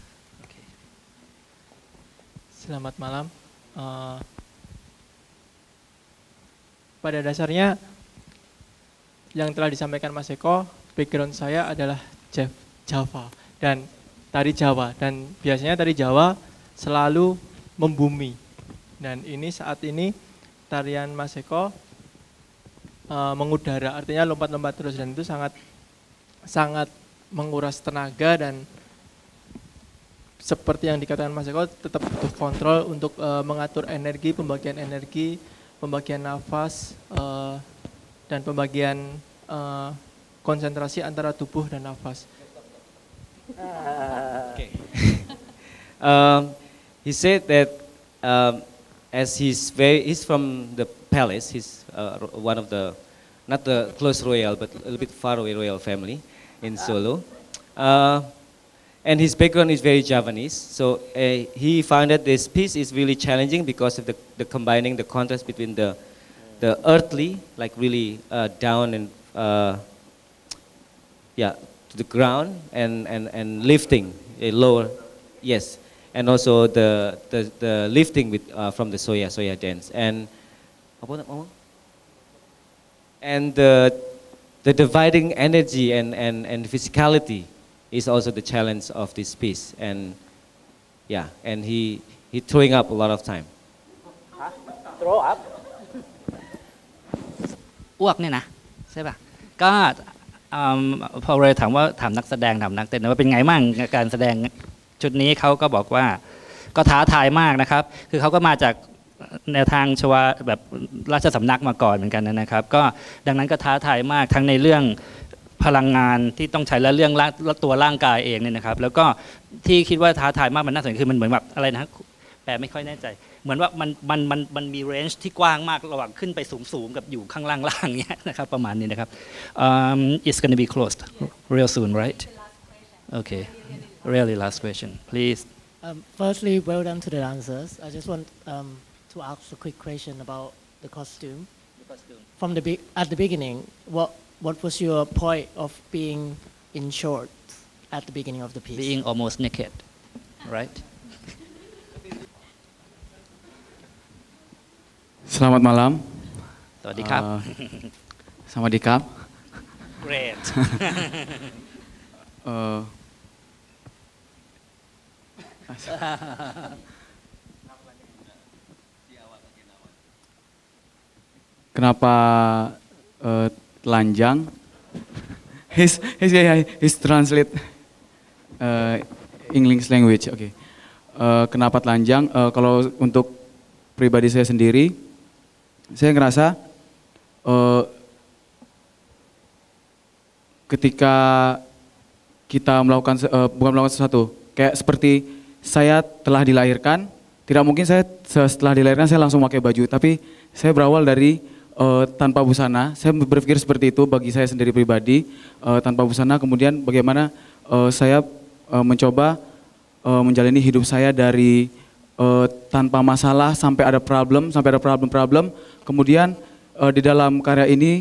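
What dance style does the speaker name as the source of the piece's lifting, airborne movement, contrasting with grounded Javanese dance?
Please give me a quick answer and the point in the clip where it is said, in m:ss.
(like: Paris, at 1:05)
soya dance, at 1:18.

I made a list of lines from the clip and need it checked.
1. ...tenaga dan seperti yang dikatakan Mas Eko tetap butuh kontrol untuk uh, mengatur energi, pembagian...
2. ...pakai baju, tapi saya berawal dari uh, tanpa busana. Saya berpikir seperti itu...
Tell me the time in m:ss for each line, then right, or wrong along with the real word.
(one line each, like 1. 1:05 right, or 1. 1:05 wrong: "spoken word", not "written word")
1. 0:27 right
2. 3:19 right.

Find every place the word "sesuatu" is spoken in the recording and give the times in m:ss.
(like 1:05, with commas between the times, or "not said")
3:13.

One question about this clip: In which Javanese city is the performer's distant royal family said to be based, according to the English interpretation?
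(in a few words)
Solo.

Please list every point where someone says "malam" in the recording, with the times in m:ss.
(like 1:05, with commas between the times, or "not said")
0:03, 2:35.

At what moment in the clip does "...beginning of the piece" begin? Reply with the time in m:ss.
2:28.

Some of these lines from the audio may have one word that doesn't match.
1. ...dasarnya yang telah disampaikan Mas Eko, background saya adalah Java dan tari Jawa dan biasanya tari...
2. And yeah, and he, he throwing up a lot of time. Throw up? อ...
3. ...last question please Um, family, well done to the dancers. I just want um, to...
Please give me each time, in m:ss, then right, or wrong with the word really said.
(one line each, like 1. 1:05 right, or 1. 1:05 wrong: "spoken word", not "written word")
1. 0:07 right
2. 1:29 right
3. 2:14 wrong: "firstly", not "family".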